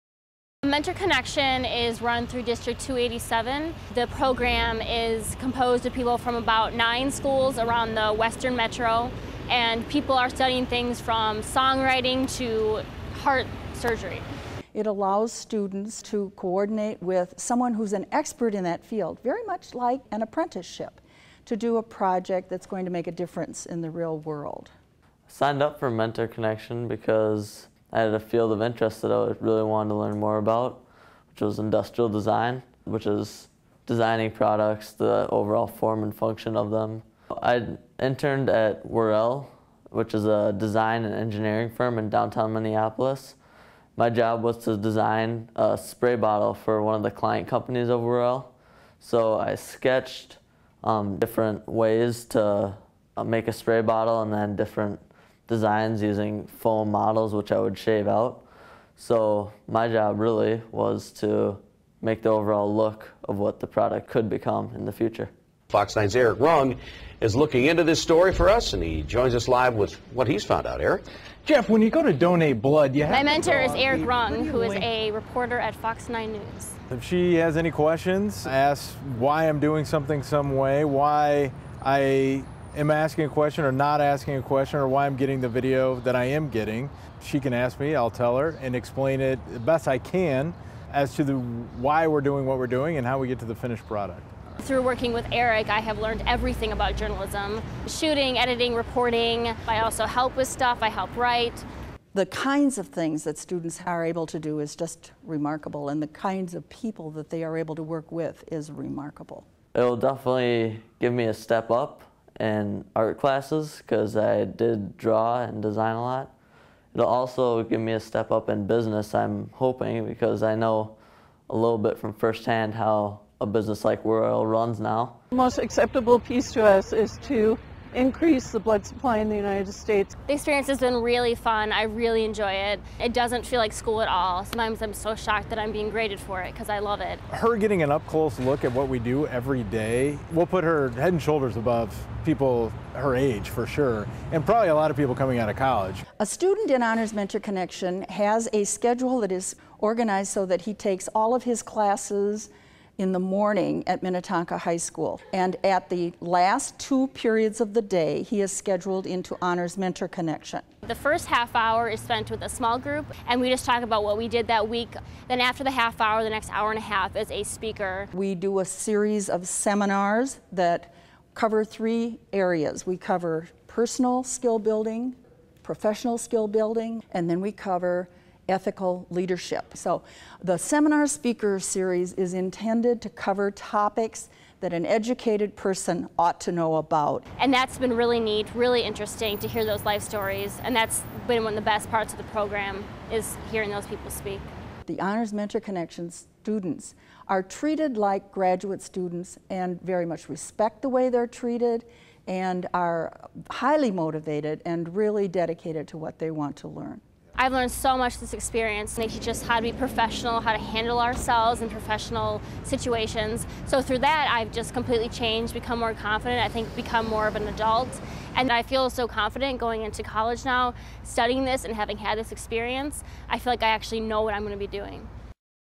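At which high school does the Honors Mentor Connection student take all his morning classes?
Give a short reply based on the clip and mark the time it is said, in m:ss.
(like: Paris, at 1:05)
Minnetonka High School, at 2:34.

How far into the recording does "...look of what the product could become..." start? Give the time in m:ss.
1:02.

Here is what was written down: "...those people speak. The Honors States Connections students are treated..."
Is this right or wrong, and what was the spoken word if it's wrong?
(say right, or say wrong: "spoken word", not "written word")
wrong: "Mentor", not "States".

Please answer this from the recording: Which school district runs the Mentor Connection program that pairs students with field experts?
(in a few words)
District 287.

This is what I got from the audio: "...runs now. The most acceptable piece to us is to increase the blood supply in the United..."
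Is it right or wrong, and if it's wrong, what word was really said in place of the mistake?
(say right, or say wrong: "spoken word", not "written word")
right.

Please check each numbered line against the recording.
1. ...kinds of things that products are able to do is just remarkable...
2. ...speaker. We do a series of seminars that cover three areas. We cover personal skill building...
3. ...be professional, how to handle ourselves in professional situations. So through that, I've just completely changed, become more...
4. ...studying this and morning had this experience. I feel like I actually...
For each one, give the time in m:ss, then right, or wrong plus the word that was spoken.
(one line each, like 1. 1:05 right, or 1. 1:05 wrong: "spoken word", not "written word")
1. 1:42 wrong: "students", not "products"
2. 2:47 right
3. 3:29 right
4. 3:41 wrong: "having", not "morning".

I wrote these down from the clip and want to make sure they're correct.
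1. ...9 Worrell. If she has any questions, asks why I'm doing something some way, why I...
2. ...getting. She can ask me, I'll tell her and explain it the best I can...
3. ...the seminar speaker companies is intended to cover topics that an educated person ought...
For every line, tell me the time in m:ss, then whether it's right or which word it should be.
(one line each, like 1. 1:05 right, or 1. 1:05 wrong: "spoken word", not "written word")
1. 1:16 wrong: "News", not "Worrell"
2. 1:26 right
3. 3:00 wrong: "series", not "companies".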